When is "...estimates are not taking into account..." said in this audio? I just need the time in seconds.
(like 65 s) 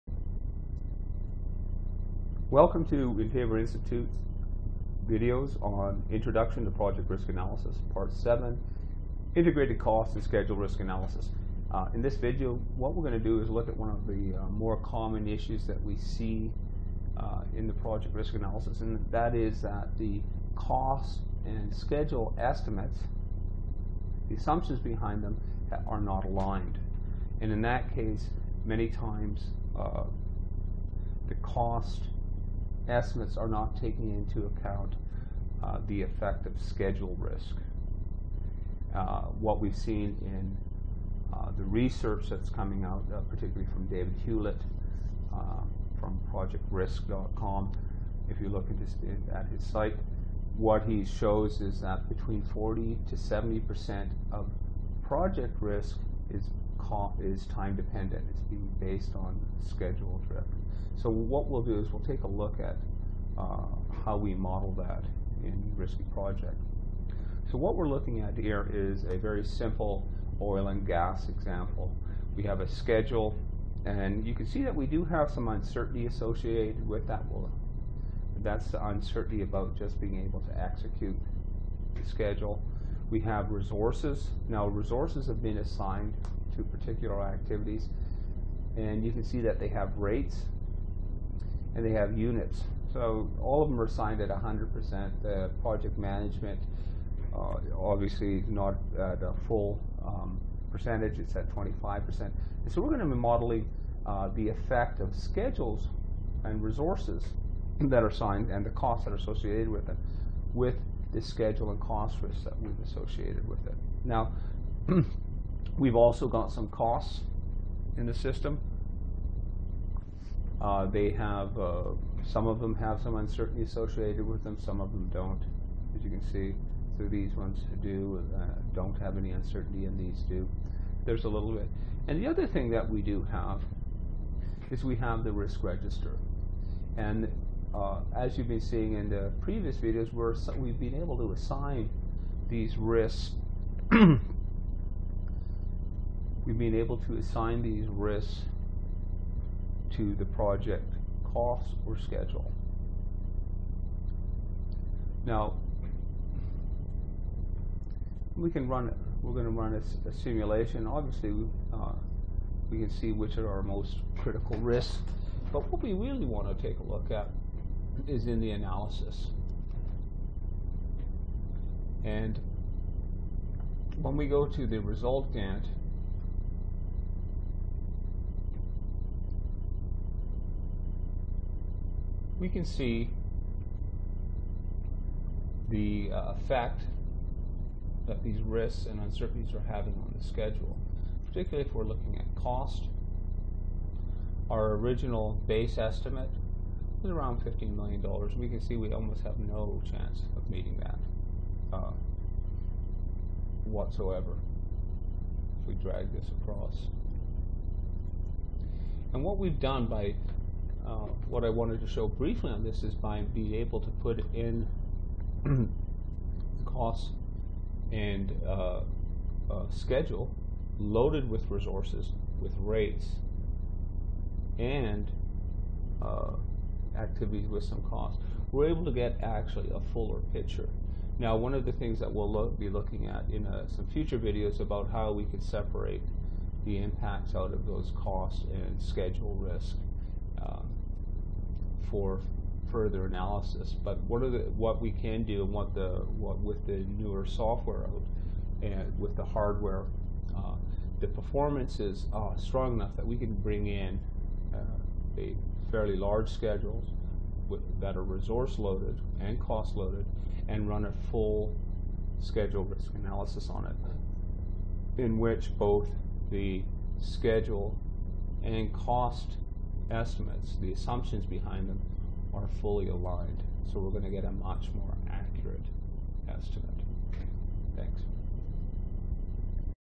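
32 s.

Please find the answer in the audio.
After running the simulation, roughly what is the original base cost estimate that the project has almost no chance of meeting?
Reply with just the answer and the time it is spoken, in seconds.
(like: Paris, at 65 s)
$15 million, at 197 s.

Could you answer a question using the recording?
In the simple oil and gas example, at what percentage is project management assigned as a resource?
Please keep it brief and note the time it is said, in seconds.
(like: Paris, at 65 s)
25%, at 101 s.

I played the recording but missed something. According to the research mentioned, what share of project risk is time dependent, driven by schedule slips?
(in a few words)
40 to 70 percent.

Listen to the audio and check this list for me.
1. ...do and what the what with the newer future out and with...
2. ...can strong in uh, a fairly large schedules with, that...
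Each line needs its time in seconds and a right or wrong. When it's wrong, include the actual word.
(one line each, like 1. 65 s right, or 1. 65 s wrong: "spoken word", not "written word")
1. 245 s wrong: "software", not "future"
2. 253 s wrong: "bring", not "strong".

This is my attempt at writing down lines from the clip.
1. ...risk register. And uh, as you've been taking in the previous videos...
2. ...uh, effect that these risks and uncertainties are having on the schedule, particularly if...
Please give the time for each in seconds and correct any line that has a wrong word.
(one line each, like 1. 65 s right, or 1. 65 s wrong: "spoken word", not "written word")
1. 135 s wrong: "seeing", not "taking"
2. 186 s right.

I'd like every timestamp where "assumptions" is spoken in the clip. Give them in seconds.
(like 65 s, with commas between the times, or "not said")
24 s, 270 s.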